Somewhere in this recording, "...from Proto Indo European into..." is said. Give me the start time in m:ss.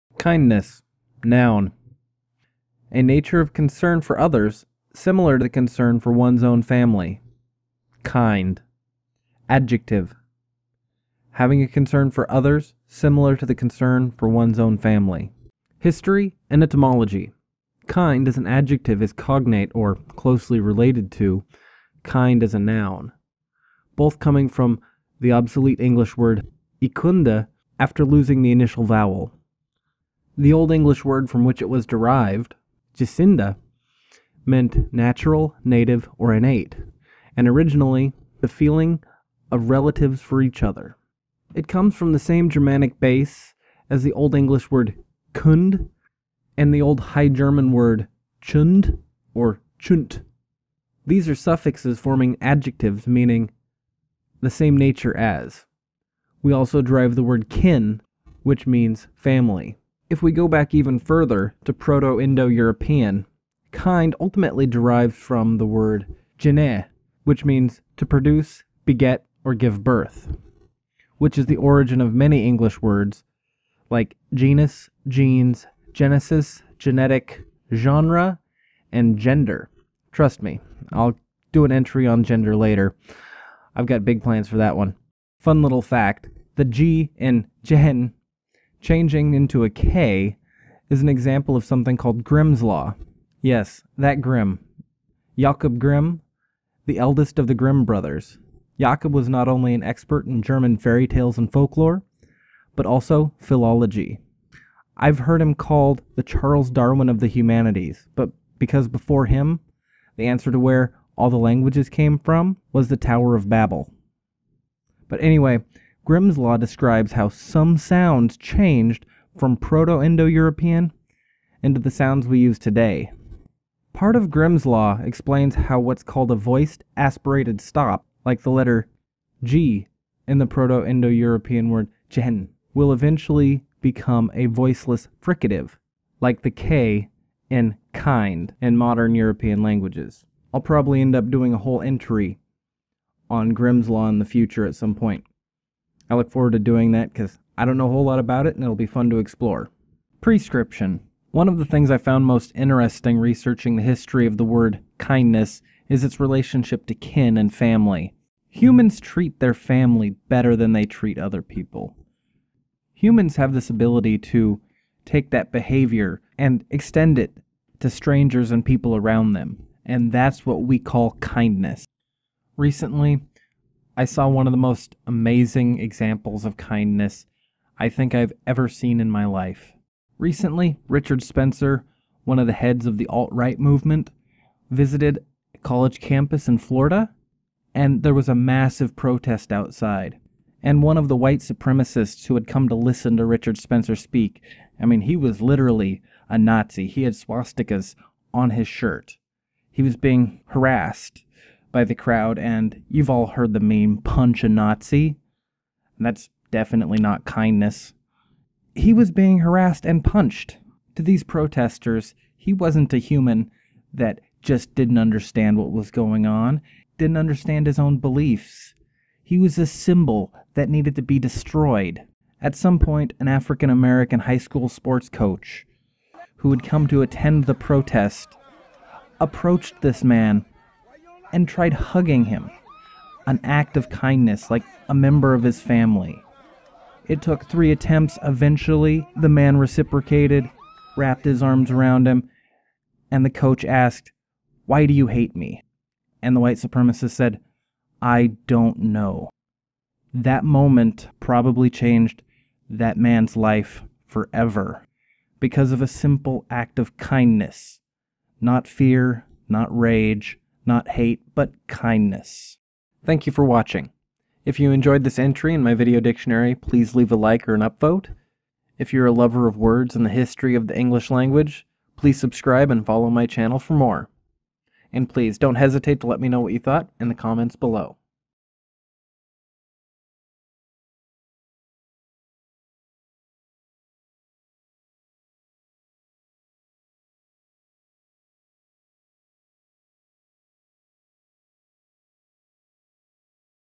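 1:59.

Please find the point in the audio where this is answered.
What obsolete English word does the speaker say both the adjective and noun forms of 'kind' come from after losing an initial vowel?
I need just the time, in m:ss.
0:26.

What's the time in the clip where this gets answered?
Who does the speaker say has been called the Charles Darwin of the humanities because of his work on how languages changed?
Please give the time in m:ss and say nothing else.
1:35.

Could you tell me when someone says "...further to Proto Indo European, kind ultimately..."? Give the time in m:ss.
1:00.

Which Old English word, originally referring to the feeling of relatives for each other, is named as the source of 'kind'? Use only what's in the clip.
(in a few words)
gecynde.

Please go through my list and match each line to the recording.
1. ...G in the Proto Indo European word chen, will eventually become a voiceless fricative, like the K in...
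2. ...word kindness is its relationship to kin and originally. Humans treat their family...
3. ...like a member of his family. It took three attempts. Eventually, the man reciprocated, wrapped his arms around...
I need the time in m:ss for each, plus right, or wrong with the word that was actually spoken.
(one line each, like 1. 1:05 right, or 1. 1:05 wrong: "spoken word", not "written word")
1. 2:09 right
2. 2:34 wrong: "family", not "originally"
3. 3:54 right.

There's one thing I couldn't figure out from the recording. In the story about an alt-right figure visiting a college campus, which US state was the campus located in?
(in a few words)
Florida.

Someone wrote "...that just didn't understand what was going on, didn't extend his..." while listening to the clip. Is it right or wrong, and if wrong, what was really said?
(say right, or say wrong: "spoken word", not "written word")
wrong: "understand", not "extend".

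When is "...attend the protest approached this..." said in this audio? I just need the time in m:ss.
3:47.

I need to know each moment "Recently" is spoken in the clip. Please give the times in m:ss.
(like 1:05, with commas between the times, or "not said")
2:52, 3:00.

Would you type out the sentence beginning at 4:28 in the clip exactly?
If you're a lover of words and the history of the English language, please subscribe and follow my channel for more.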